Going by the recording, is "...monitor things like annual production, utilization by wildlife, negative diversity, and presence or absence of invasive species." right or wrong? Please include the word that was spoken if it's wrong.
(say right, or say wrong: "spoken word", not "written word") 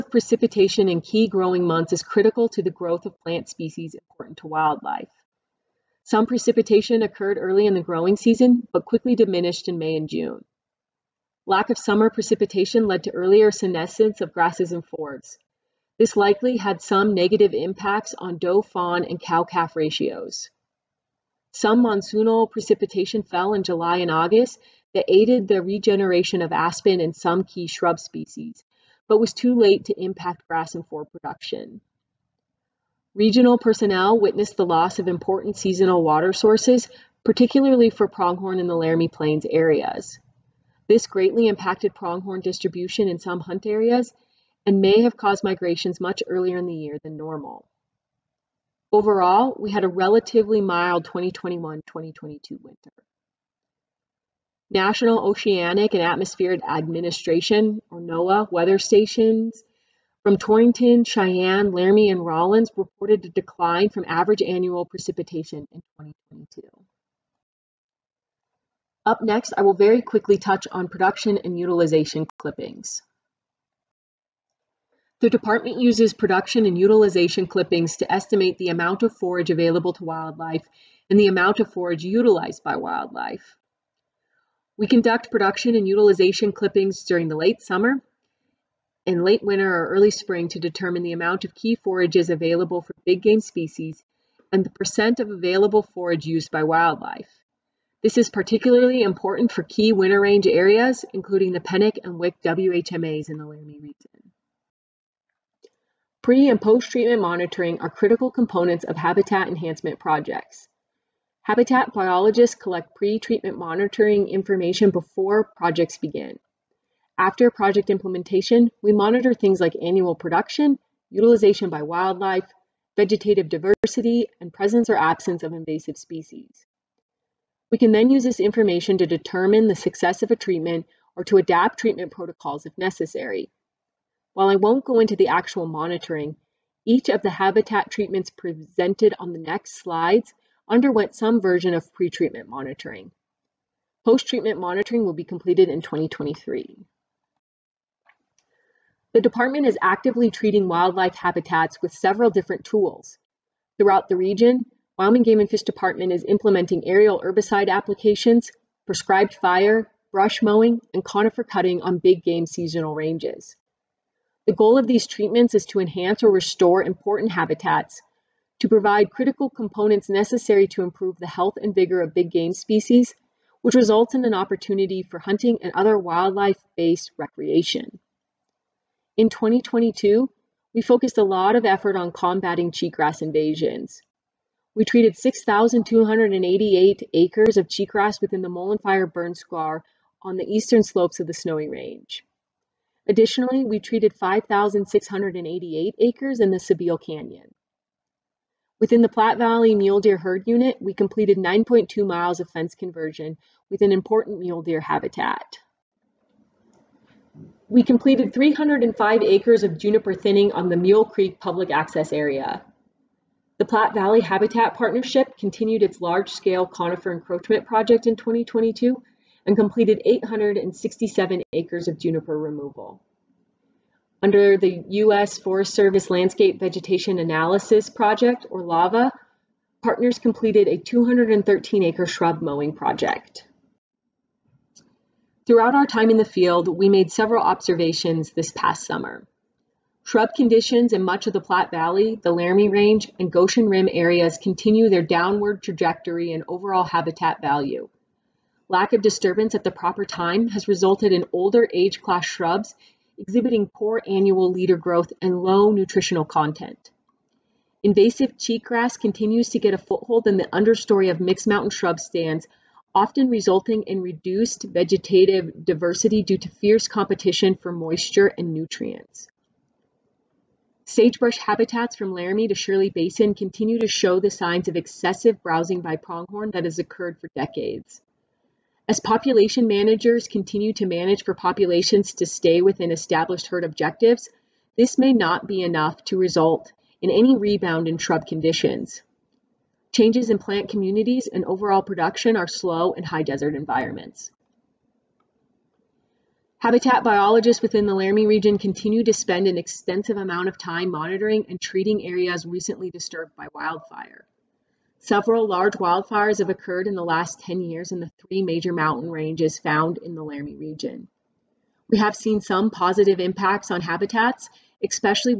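wrong: "vegetative", not "negative".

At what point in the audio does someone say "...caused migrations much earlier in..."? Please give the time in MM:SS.
00:45.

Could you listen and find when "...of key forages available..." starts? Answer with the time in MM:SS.
01:31.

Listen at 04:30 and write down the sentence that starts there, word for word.
Sagebrush habitats from Laramie to Shirley Basin continue to show the signs of excessive browsing by pronghorn that has occurred for decades.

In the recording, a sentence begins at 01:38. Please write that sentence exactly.
This is particularly important for key winter range areas, including the Pennock and Wick WHMAs in the Laramie region.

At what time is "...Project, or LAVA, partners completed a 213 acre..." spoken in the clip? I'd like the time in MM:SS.
03:47.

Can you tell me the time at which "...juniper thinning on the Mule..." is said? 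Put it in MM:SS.
03:29.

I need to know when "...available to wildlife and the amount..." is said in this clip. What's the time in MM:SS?
01:19.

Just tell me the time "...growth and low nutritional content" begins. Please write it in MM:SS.
04:14.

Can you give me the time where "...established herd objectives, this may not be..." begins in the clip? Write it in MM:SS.
04:42.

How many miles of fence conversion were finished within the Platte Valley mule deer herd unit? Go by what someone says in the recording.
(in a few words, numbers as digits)
9.2 miles.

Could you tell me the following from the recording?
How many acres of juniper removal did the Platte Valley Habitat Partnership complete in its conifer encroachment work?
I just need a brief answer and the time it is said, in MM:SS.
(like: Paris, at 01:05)
867, at 03:40.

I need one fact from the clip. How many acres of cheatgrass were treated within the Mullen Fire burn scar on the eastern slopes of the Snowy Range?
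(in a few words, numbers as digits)
6,288.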